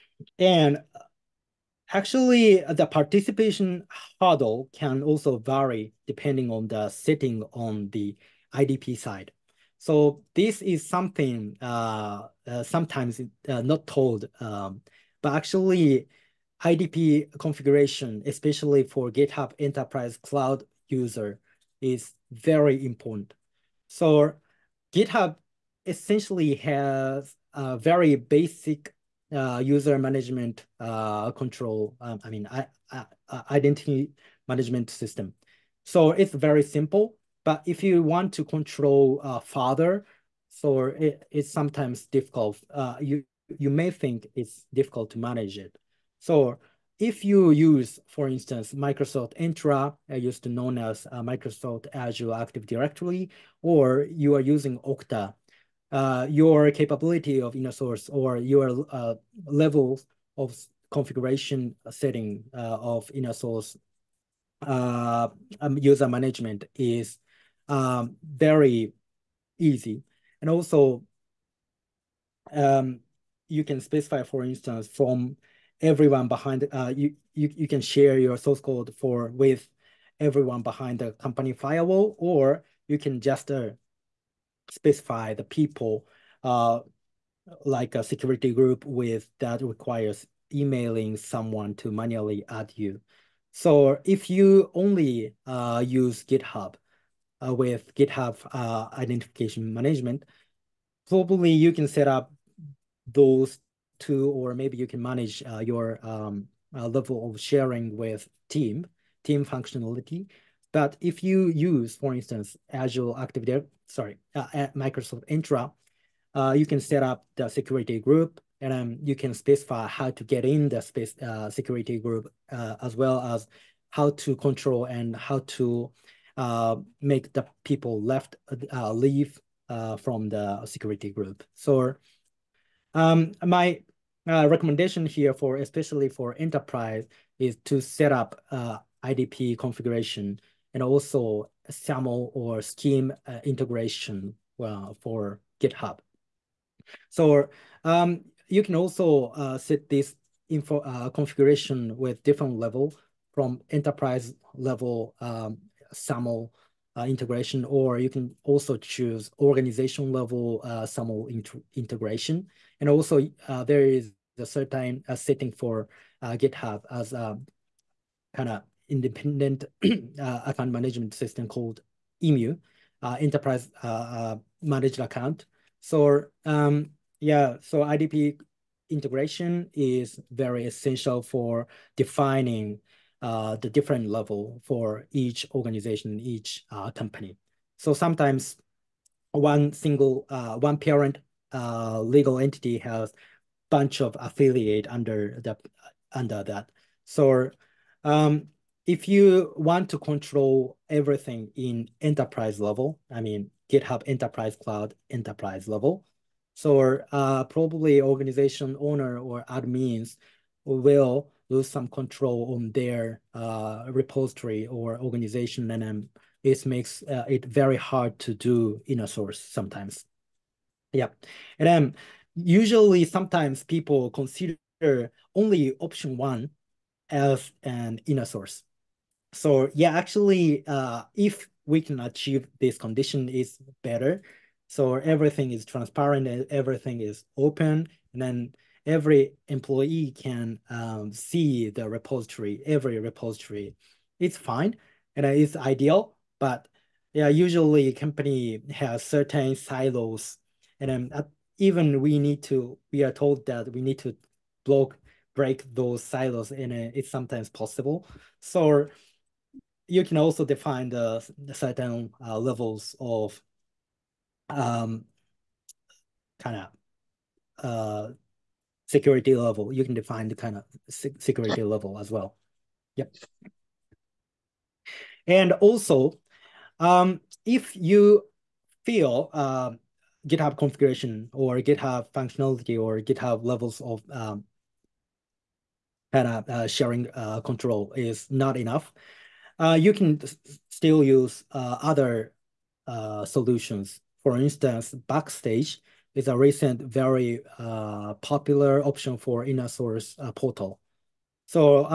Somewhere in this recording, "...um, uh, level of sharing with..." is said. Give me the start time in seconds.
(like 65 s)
106 s.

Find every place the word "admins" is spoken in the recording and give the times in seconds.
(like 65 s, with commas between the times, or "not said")
209 s.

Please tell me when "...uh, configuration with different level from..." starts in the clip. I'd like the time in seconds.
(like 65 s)
150 s.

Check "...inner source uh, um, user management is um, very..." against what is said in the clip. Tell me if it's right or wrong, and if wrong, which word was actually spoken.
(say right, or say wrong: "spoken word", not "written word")
right.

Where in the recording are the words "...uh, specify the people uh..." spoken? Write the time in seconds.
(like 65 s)
83 s.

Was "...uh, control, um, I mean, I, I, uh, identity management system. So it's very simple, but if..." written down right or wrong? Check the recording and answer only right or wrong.
right.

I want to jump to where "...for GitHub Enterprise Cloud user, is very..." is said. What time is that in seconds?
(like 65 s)
18 s.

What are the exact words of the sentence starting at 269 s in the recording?
You can define the kind of security level as well.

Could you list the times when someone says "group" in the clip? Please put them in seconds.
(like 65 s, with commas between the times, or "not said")
88 s, 117 s, 121 s, 131 s.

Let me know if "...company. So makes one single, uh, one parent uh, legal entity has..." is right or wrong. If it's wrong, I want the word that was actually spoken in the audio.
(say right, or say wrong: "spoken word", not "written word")
wrong: "sometimes", not "makes".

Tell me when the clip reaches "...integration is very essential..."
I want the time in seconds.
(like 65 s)
178 s.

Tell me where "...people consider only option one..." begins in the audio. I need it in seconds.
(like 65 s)
223 s.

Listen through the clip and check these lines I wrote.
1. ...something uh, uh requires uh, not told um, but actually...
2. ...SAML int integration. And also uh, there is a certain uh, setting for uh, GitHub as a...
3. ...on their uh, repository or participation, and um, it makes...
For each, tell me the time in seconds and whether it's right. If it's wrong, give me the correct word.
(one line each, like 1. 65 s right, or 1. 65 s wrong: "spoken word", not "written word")
1. 10 s wrong: "sometimes", not "requires"
2. 160 s right
3. 212 s wrong: "organization", not "participation".